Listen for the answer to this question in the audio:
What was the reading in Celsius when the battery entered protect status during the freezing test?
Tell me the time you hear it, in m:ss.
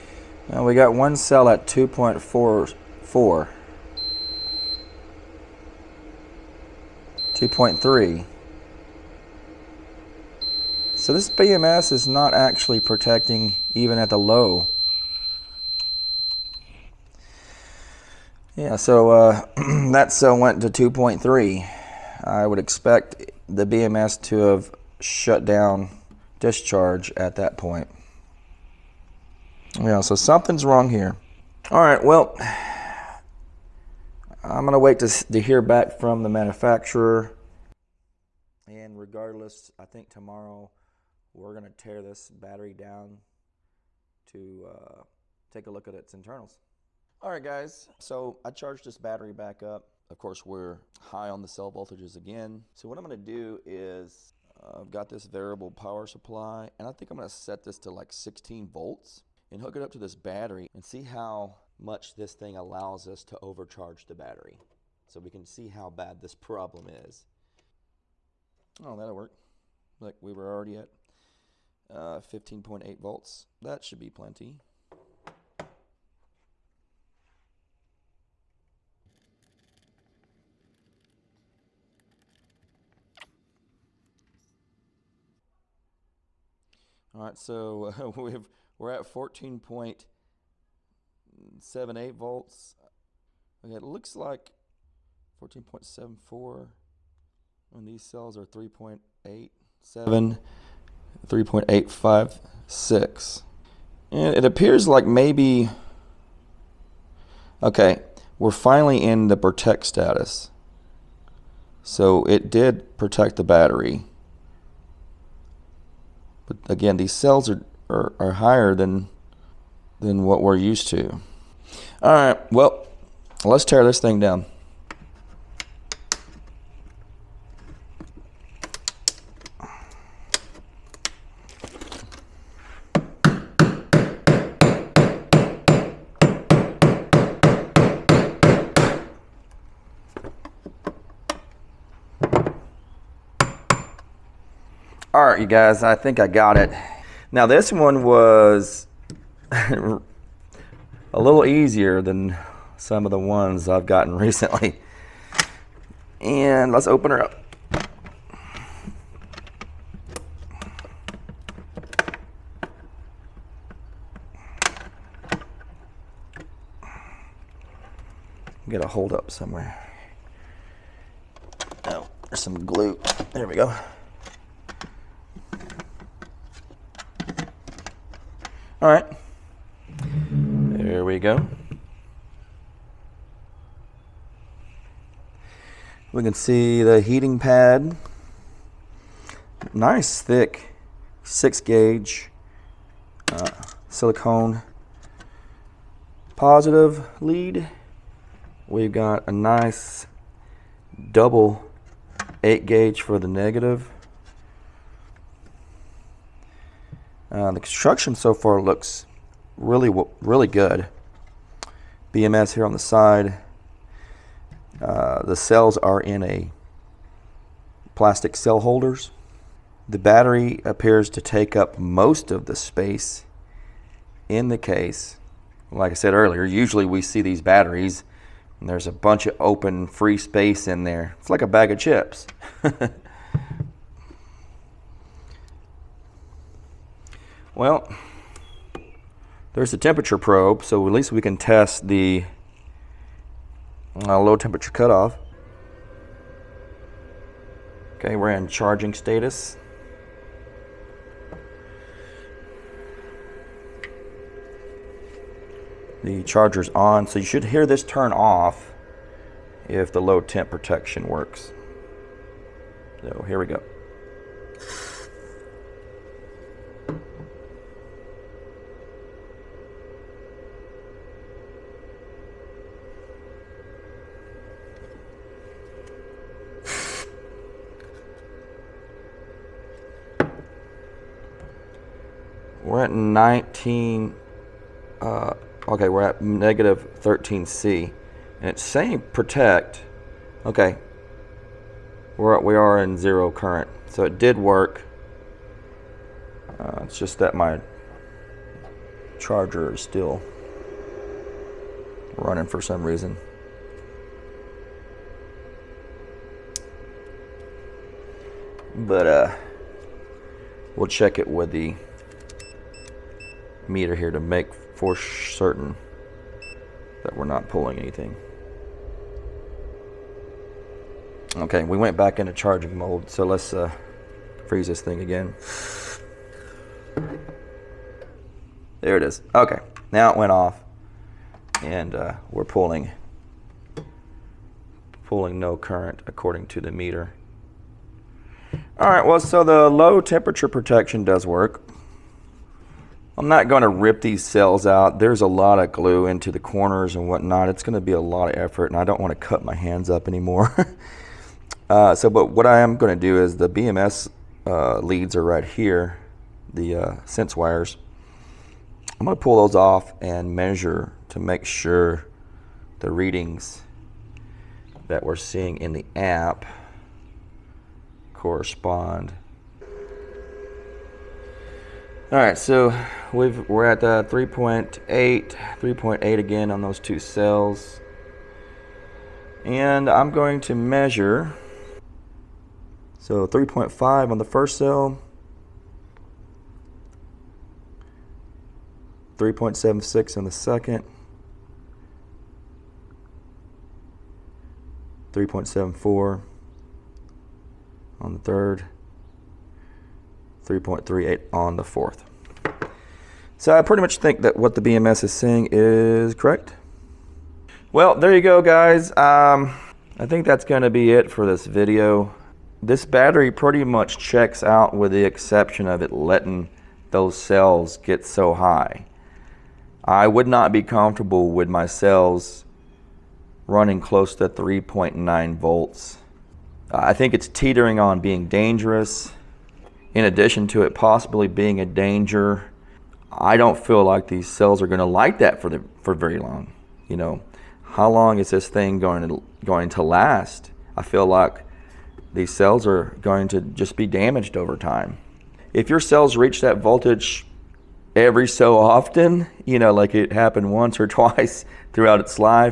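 4:46.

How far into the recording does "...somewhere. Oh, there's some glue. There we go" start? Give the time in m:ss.
2:49.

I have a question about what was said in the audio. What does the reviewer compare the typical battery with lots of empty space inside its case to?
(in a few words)
A bag of chips.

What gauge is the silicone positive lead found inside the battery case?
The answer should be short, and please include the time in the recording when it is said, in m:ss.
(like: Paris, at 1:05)
6 gauge, at 3:11.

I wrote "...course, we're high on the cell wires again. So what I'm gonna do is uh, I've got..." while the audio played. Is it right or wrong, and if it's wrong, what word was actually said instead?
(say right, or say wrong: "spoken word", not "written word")
wrong: "voltages", not "wires".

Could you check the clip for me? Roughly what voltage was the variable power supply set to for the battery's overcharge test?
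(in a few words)
16 volts.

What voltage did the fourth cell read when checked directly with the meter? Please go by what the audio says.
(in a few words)
3.38.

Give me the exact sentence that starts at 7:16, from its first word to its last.
You know, how long is this thing going to going to last?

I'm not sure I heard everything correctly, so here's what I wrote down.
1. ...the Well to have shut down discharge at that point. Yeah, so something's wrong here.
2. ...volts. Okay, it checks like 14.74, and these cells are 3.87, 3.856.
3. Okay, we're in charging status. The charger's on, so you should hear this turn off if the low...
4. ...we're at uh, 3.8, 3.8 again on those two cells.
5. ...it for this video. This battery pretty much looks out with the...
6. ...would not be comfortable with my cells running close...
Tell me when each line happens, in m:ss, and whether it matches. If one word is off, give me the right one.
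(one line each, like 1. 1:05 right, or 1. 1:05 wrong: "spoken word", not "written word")
1. 0:23 wrong: "BMS", not "Well"
2. 1:32 wrong: "looks", not "checks"
3. 4:07 right
4. 6:13 right
5. 6:50 wrong: "checks", not "looks"
6. 7:00 right.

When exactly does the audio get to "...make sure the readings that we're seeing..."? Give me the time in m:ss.
6:01.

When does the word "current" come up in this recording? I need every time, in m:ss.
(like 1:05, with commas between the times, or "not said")
4:53, 5:35.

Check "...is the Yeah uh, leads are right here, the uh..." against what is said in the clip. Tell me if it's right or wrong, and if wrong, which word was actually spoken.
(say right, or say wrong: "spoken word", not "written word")
wrong: "BMS", not "Yeah".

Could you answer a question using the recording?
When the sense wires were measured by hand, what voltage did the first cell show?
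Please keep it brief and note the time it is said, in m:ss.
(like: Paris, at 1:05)
3.5, at 6:23.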